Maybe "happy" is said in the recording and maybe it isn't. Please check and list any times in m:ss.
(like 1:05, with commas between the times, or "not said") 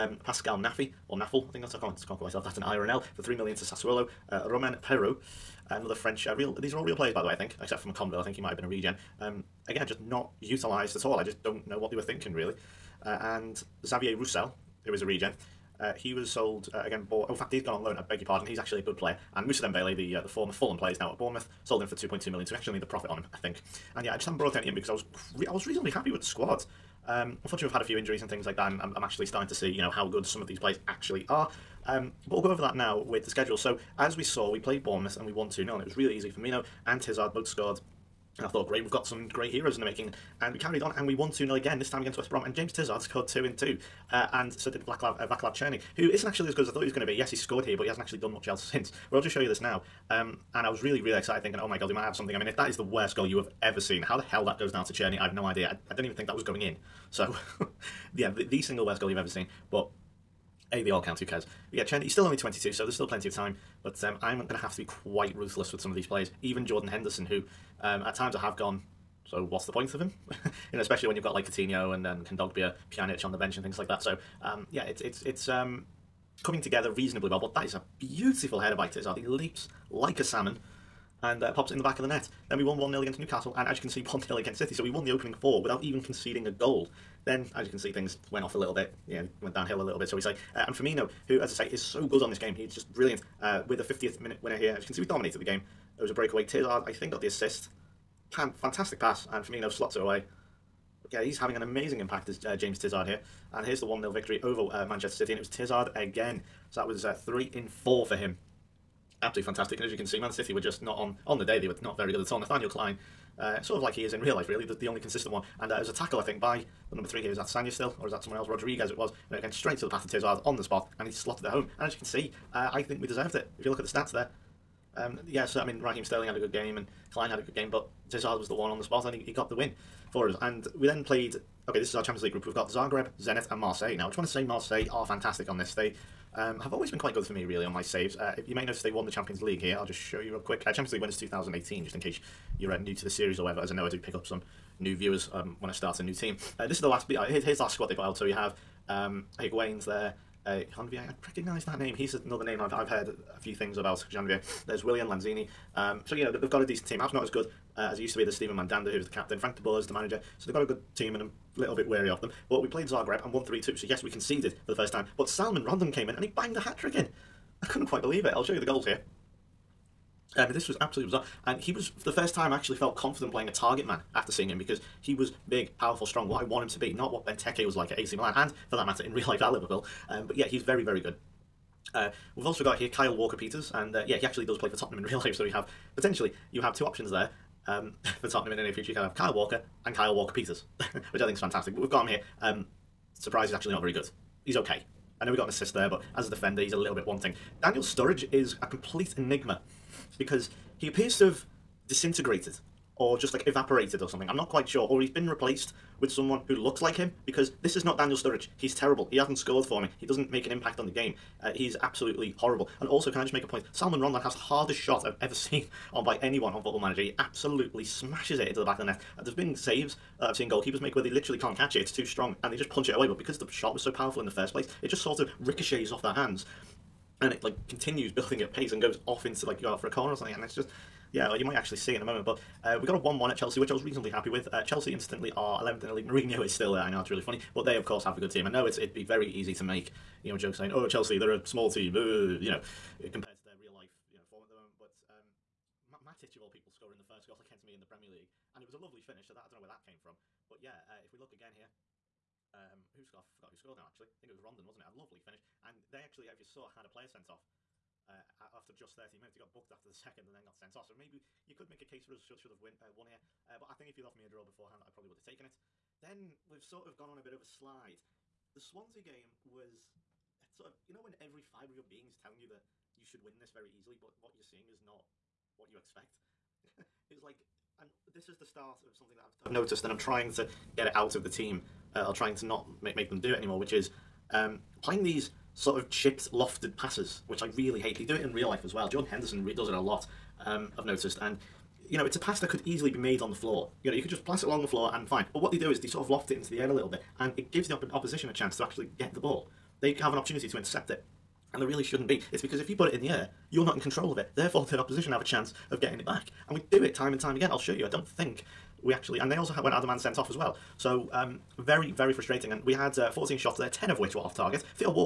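0:25, 3:54.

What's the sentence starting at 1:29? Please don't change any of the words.
Yeah, went downhill a little bit, so we say.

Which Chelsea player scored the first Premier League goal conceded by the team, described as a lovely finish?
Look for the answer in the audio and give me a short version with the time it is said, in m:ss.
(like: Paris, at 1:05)
Matic, at 4:05.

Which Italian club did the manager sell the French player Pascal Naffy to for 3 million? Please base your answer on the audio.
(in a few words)
Sassuolo.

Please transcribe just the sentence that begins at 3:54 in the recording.
Uh, Chelsea instantly are 11th in the league.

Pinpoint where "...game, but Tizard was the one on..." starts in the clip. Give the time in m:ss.
2:07.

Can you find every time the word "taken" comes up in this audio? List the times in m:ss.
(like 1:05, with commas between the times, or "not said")
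4:25.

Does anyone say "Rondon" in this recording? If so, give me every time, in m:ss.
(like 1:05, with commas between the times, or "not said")
2:45, 3:34, 4:14.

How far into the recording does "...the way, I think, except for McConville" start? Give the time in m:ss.
0:07.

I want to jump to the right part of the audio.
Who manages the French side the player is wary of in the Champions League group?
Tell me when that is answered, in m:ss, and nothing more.
2:39.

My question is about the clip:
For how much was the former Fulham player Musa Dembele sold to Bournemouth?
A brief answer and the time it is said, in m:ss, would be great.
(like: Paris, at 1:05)
2.2 million, at 0:21.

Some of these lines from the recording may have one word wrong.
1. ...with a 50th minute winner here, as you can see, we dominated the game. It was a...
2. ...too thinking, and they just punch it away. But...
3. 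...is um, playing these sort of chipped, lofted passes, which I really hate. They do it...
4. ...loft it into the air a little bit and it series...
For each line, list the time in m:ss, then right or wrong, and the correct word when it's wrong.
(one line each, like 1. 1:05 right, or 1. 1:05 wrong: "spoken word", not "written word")
1. 1:33 right
2. 3:41 wrong: "strong", not "thinking"
3. 4:43 right
4. 4:56 wrong: "gives", not "series".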